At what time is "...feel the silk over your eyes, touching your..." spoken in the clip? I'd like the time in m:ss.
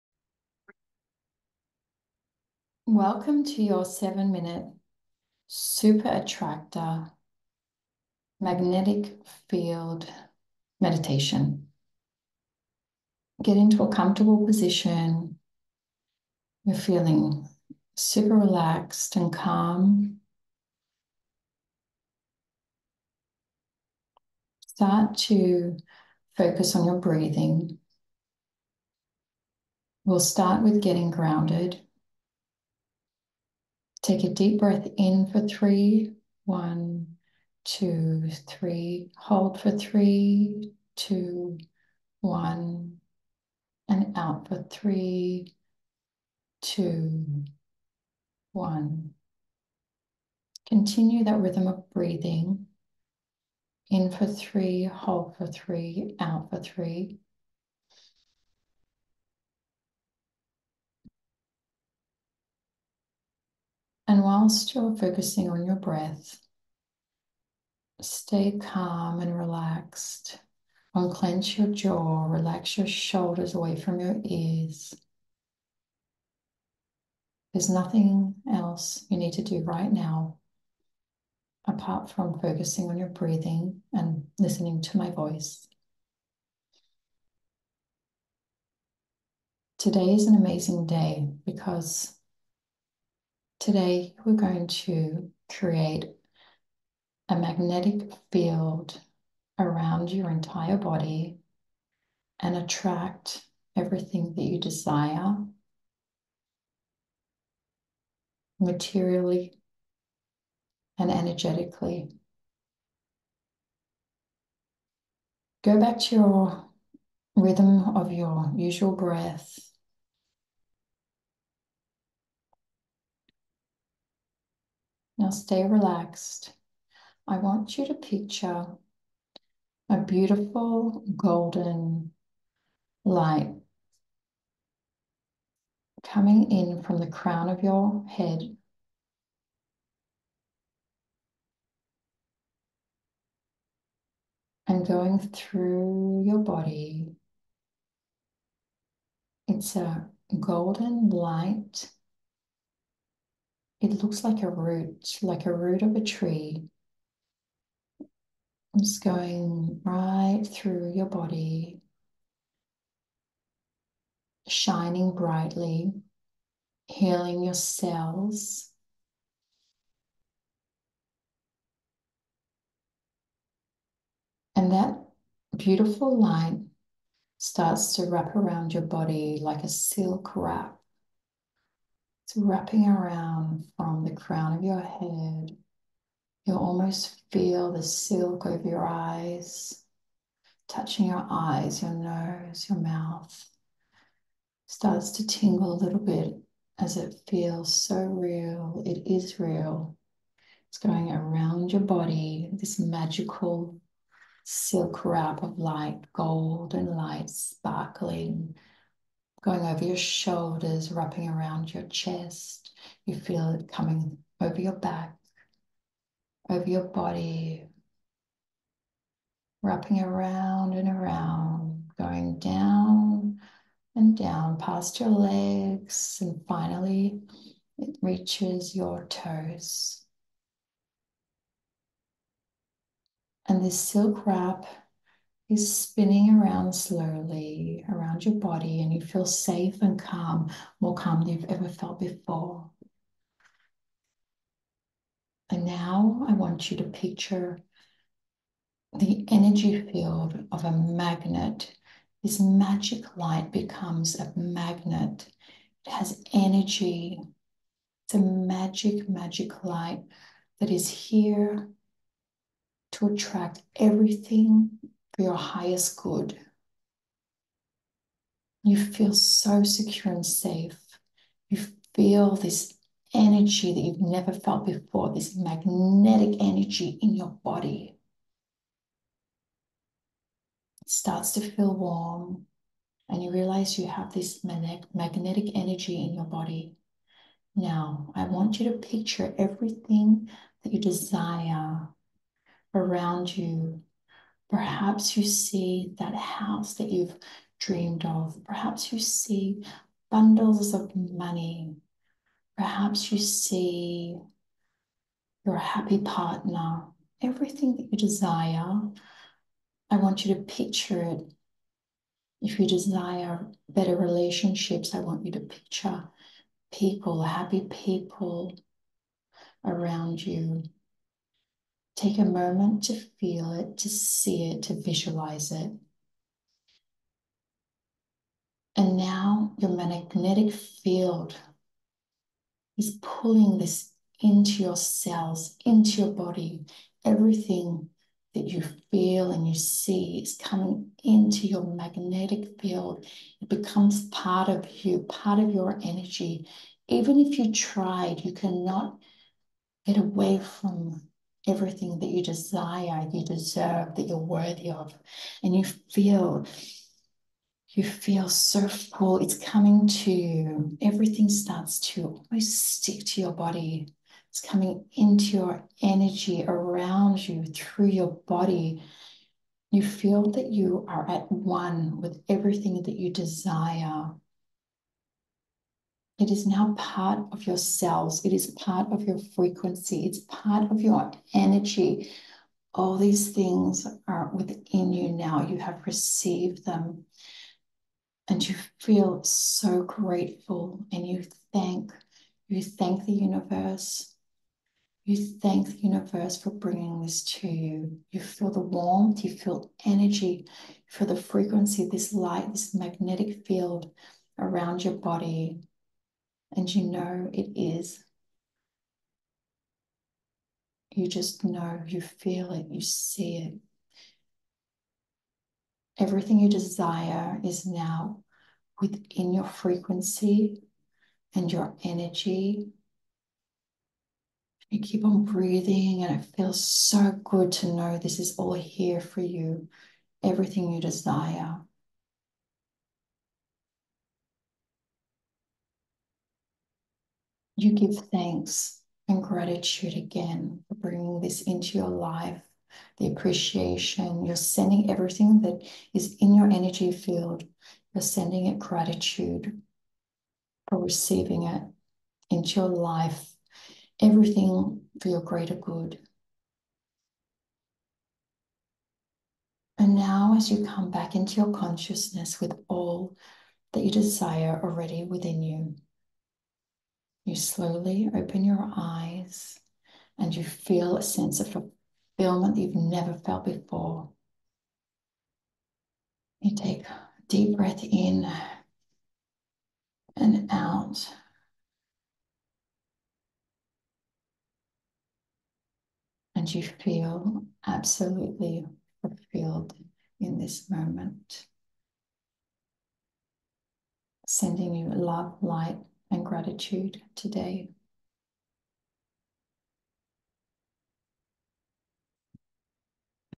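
3:07.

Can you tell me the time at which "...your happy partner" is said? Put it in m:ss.
5:05.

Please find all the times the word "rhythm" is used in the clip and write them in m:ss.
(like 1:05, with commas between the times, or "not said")
0:51, 1:57.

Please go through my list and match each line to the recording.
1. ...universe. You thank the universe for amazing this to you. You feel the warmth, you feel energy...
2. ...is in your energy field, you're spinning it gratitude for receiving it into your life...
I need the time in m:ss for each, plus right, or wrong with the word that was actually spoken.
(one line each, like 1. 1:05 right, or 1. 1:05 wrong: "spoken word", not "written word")
1. 6:33 wrong: "bringing", not "amazing"
2. 7:25 wrong: "sending", not "spinning".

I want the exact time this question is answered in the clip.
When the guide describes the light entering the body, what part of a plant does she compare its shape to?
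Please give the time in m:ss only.
2:35.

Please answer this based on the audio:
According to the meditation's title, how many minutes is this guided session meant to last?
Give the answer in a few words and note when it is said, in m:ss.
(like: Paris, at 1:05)
7, at 0:03.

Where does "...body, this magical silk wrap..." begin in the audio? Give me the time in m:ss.
3:21.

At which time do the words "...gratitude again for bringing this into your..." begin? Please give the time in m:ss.
7:19.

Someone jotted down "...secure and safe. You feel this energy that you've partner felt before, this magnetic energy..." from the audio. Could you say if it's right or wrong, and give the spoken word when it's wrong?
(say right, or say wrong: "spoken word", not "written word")
wrong: "never", not "partner".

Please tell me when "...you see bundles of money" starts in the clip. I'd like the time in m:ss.
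4:58.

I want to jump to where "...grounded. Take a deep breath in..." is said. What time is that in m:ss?
0:31.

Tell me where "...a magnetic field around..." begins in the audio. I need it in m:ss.
1:37.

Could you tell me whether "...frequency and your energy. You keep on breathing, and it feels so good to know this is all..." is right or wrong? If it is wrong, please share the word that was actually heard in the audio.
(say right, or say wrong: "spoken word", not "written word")
right.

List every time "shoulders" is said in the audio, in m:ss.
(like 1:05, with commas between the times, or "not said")
1:12, 3:29.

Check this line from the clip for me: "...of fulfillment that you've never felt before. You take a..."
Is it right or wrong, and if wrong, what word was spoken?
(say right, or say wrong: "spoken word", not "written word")
right.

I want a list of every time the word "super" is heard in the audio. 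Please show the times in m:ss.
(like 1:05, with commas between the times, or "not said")
0:05, 0:17.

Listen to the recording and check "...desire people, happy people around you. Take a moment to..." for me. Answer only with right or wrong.
wrong.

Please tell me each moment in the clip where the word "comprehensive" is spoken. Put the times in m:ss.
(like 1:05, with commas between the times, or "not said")
not said.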